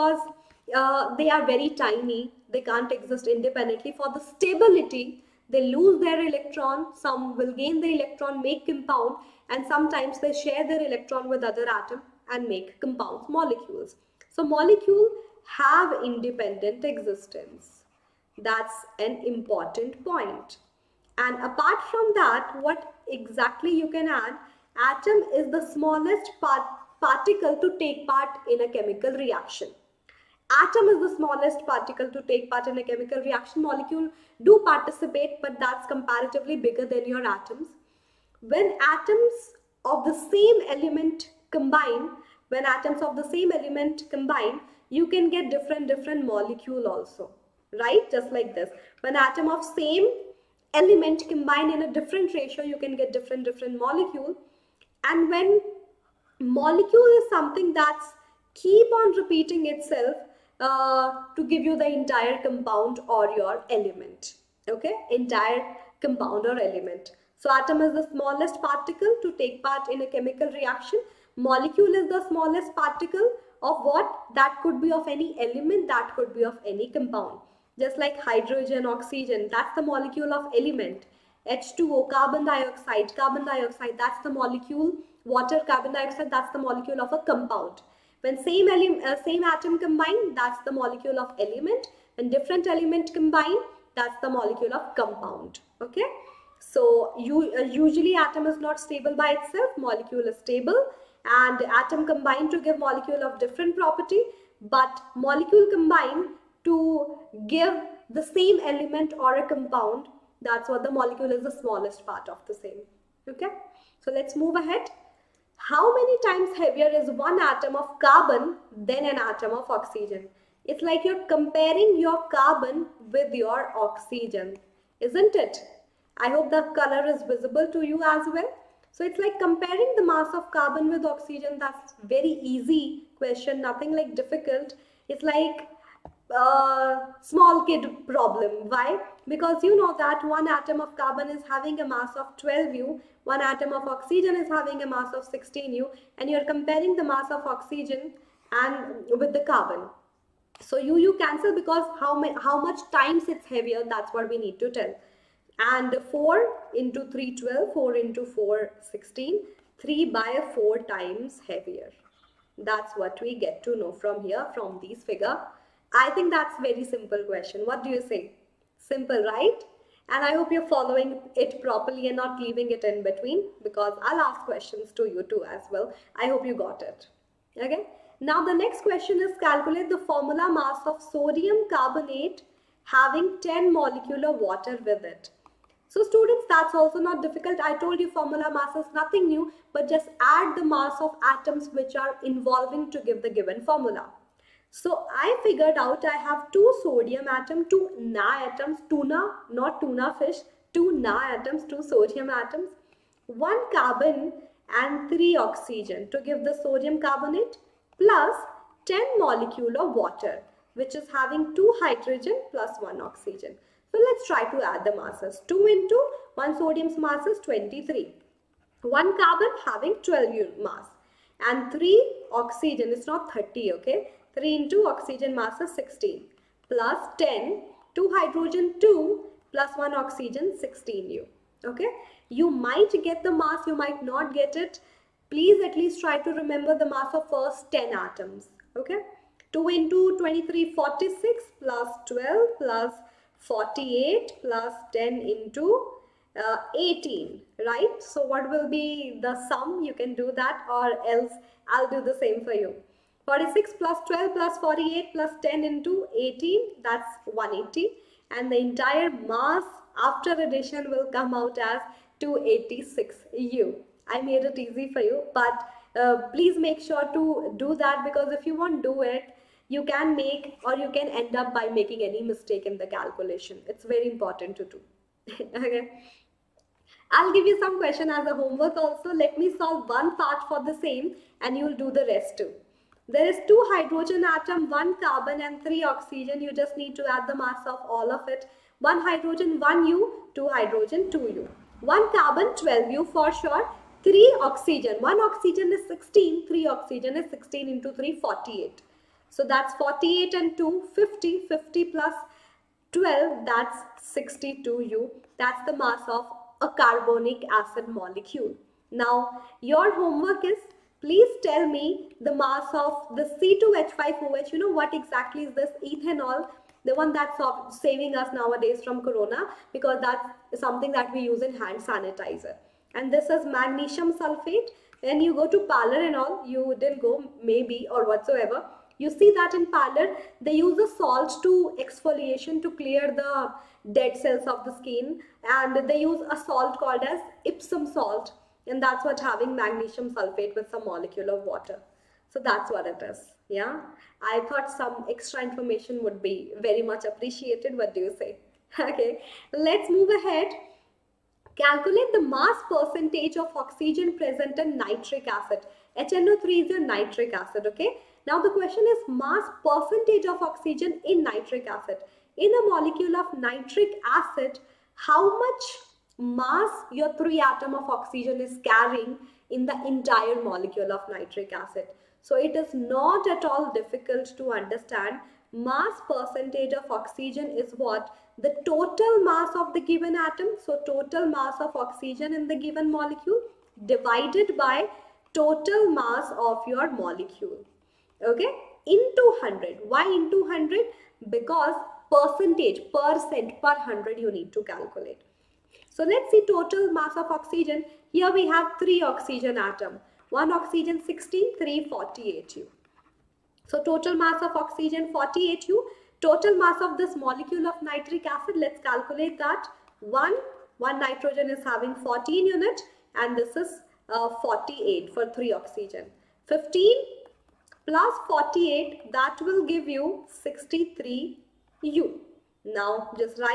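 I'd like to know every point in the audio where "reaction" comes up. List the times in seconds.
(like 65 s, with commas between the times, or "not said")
29 s, 33 s, 70 s.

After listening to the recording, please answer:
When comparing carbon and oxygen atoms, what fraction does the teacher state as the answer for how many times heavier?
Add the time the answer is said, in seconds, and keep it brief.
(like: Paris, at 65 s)
3/4, at 159 s.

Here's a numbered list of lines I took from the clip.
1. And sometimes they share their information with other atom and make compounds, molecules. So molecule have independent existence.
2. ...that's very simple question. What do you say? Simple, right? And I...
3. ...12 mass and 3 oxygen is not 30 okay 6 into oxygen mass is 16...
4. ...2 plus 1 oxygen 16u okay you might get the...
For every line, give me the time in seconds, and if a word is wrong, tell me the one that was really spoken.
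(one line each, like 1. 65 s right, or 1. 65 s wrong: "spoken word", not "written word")
1. 9 s wrong: "electron", not "information"
2. 166 s right
3. 219 s wrong: "3", not "6"
4. 228 s right.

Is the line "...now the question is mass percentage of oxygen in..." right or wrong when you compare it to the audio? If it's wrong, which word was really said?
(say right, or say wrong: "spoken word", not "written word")
right.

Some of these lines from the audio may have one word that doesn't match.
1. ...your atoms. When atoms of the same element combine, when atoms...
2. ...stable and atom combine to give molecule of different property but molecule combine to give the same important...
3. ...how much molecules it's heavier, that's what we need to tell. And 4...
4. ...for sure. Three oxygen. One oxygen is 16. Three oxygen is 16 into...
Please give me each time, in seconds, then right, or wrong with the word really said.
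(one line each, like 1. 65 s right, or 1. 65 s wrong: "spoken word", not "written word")
1. 37 s right
2. 100 s wrong: "element", not "important"
3. 152 s wrong: "times", not "molecules"
4. 293 s right.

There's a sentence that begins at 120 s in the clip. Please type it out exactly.
It's like you're comparing your carbon with your oxygen, isn't it?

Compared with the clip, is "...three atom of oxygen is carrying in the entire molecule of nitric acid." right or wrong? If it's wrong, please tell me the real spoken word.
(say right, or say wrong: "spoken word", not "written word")
right.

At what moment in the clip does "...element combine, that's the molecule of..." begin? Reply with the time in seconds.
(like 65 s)
92 s.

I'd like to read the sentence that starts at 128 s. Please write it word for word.
So it's like comparing the mass of carbon with oxygen.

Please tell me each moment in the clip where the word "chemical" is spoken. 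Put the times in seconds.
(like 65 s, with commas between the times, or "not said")
28 s, 32 s, 70 s.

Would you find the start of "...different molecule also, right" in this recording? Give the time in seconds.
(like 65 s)
45 s.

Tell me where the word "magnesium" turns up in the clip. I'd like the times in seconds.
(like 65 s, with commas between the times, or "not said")
323 s, 339 s.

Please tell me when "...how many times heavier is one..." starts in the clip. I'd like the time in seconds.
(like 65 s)
115 s.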